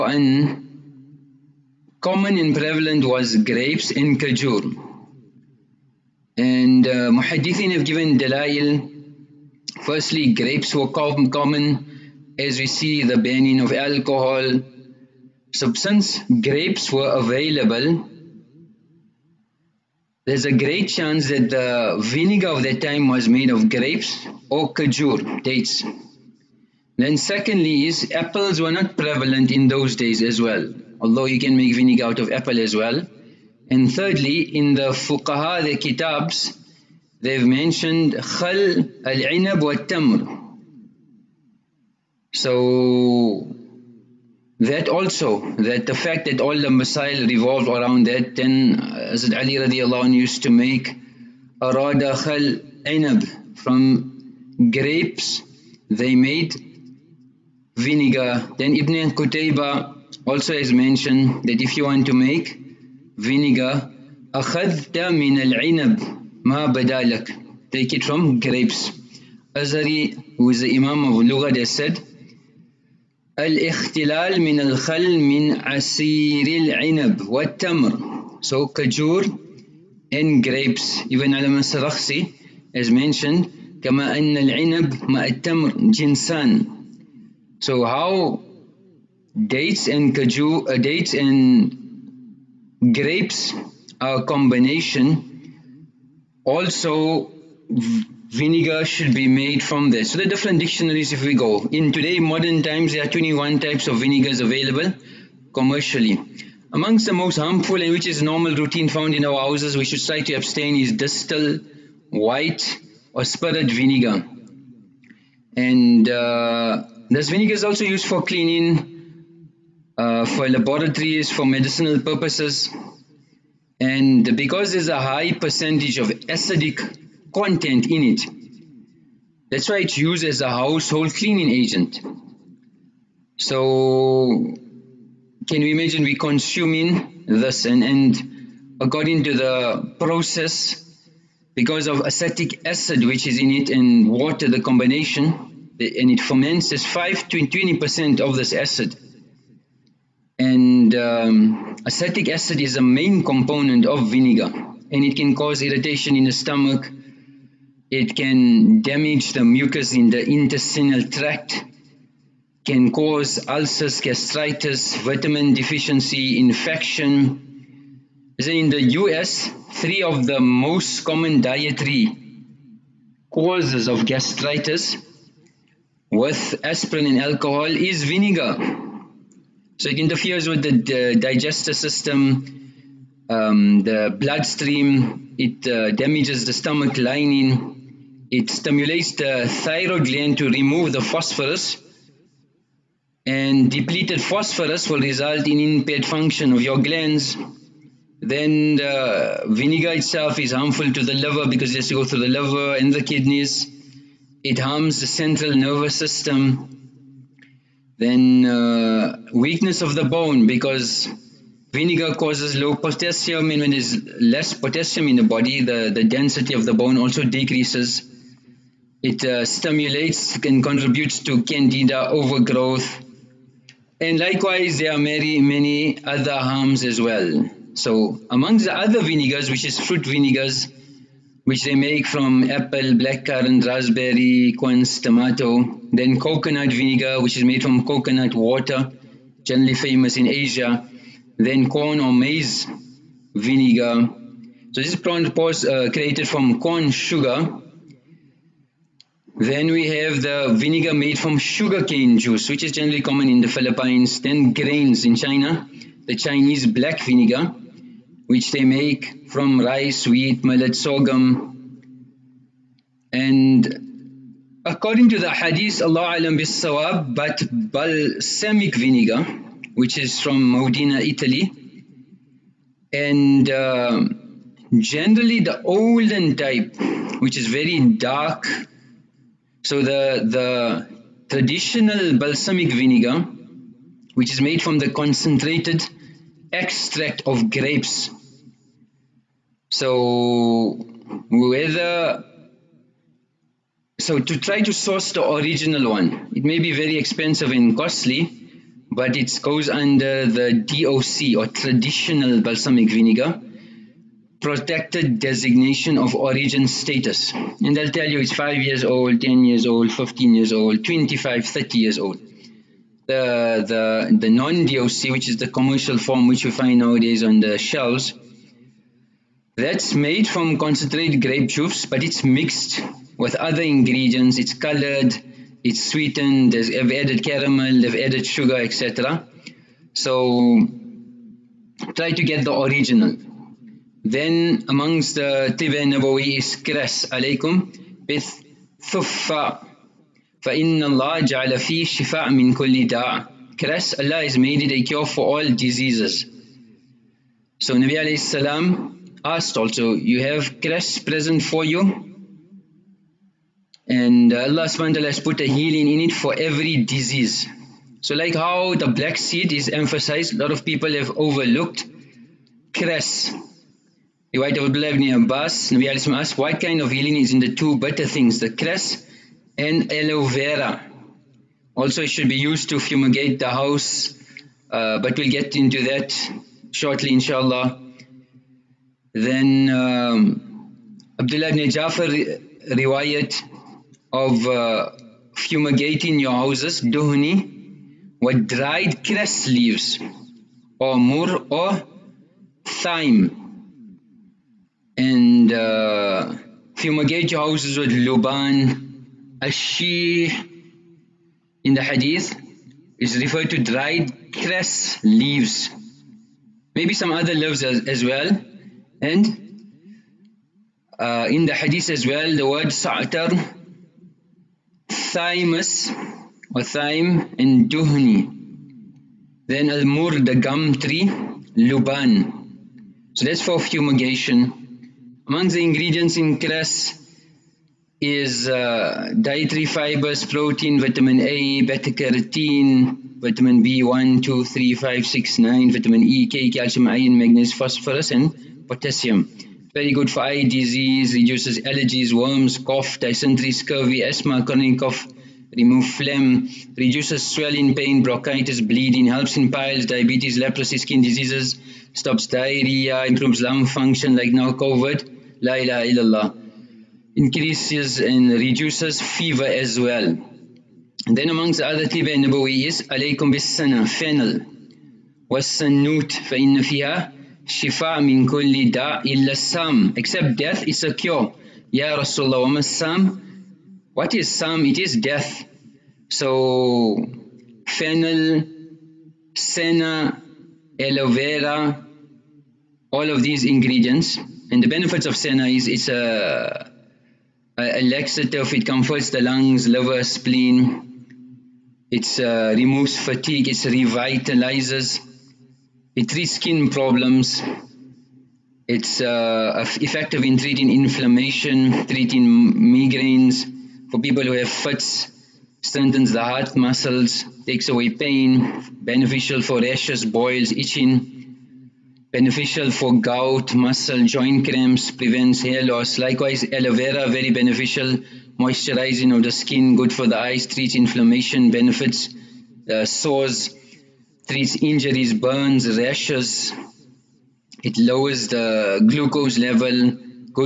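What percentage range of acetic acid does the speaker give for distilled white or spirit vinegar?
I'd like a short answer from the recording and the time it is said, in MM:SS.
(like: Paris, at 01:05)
5 to 20%, at 02:26.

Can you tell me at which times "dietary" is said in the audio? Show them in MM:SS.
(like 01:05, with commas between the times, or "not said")
02:51, 07:09.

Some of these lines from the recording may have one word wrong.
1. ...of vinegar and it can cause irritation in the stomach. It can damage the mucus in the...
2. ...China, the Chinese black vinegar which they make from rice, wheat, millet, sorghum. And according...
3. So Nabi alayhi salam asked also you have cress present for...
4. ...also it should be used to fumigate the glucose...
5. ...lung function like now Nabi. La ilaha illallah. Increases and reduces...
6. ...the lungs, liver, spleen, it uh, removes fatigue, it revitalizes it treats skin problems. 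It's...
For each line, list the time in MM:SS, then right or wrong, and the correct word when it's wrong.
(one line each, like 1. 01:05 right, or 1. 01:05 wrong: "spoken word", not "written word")
1. 02:33 right
2. 04:15 right
3. 05:47 right
4. 06:11 wrong: "house", not "glucose"
5. 07:33 wrong: "COVID", not "Nabi"
6. 08:09 right.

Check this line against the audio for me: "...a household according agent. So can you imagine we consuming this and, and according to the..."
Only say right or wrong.
wrong.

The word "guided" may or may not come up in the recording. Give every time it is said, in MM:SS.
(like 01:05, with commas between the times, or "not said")
not said.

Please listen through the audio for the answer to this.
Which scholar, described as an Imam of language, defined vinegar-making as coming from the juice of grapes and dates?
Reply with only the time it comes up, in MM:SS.
01:09.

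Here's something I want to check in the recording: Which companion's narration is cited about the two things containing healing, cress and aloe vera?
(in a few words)
Abdullah ibn Abbas.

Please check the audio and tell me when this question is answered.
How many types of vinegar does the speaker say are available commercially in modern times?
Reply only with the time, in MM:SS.
01:43.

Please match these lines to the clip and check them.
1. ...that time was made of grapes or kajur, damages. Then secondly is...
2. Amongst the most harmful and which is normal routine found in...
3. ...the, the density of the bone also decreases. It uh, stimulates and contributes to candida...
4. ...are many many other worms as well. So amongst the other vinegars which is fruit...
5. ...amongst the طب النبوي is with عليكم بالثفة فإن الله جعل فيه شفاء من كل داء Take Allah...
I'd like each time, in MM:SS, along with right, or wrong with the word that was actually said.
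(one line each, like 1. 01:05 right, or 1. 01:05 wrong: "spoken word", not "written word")
1. 00:22 wrong: "dates", not "damages"
2. 01:46 right
3. 03:35 right
4. 03:44 wrong: "harms", not "worms"
5. 05:34 wrong: "Kras", not "Take".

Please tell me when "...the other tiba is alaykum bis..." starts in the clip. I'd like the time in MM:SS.
07:41.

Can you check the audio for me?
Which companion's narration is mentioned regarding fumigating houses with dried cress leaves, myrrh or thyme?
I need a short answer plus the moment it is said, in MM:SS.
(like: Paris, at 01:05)
Abdullah ibn Jafar, at 06:21.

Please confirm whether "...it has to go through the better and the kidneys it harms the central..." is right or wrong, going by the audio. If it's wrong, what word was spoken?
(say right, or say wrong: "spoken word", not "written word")
wrong: "liver", not "better".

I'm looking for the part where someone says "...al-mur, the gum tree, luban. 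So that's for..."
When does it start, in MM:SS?
06:59.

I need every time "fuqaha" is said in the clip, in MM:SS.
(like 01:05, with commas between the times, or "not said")
00:34.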